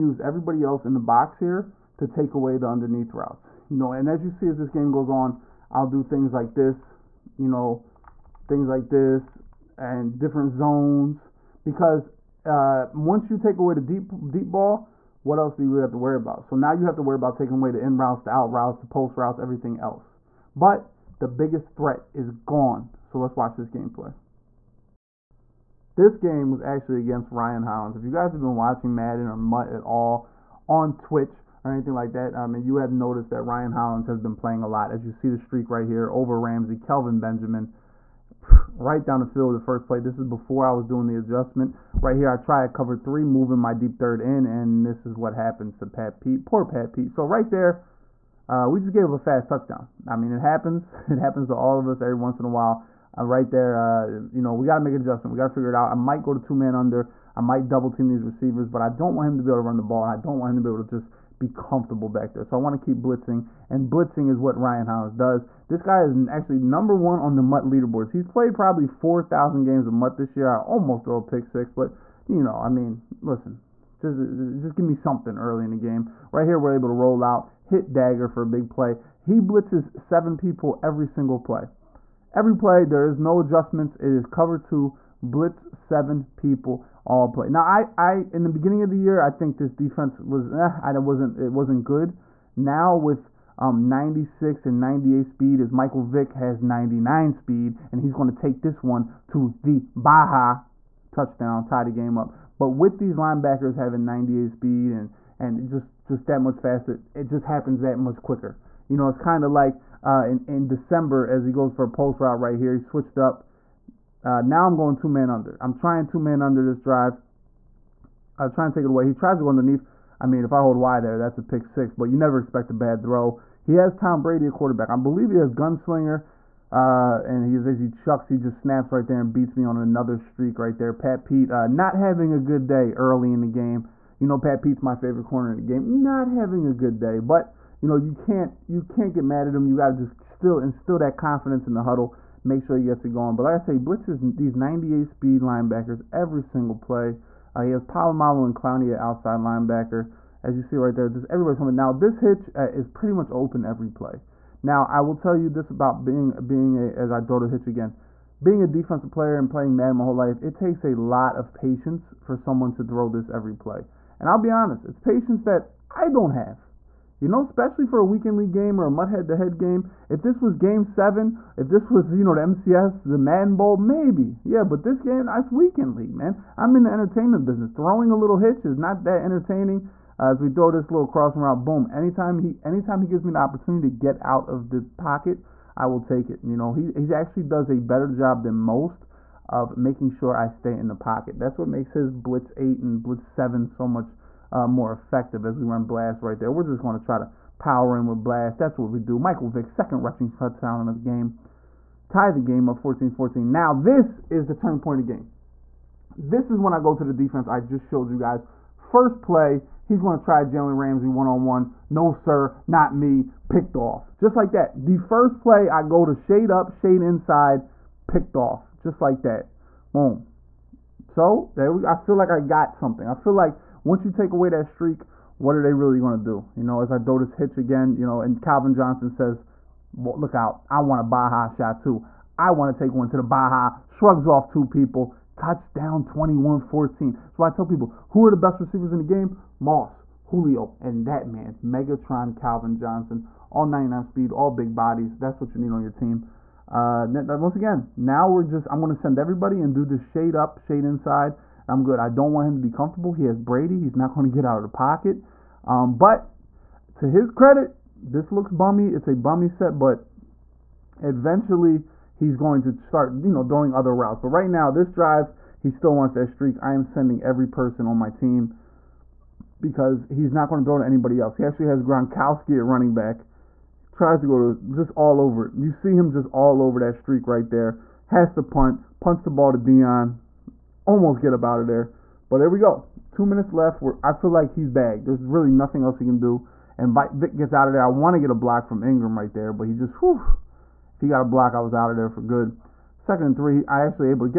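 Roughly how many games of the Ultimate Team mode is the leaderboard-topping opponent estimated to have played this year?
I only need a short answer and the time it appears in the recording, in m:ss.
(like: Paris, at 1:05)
4,000, at 1:08.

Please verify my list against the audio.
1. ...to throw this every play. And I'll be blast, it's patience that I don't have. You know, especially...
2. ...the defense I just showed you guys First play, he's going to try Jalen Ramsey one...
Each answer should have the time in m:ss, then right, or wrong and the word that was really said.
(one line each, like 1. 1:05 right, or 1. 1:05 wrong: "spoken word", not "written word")
1. 2:42 wrong: "honest", not "blast"
2. 3:27 right.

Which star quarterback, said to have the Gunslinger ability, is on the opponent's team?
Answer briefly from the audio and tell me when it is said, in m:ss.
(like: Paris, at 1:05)
Tom Brady, at 2:03.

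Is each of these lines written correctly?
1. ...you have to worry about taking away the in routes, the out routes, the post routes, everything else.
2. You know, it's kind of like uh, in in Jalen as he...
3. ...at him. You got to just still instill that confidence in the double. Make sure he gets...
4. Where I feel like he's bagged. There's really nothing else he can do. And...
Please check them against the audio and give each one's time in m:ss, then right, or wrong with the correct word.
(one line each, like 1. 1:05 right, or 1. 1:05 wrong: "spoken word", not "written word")
1. 0:16 right
2. 1:48 wrong: "December", not "Jalen"
3. 2:19 wrong: "huddle", not "double"
4. 4:43 right.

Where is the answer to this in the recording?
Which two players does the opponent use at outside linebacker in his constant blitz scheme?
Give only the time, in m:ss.
2:27.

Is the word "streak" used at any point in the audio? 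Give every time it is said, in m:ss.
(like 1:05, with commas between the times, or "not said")
0:35, 2:10, 3:44, 4:26, 4:36.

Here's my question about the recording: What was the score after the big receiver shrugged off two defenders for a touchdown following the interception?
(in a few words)
21-14.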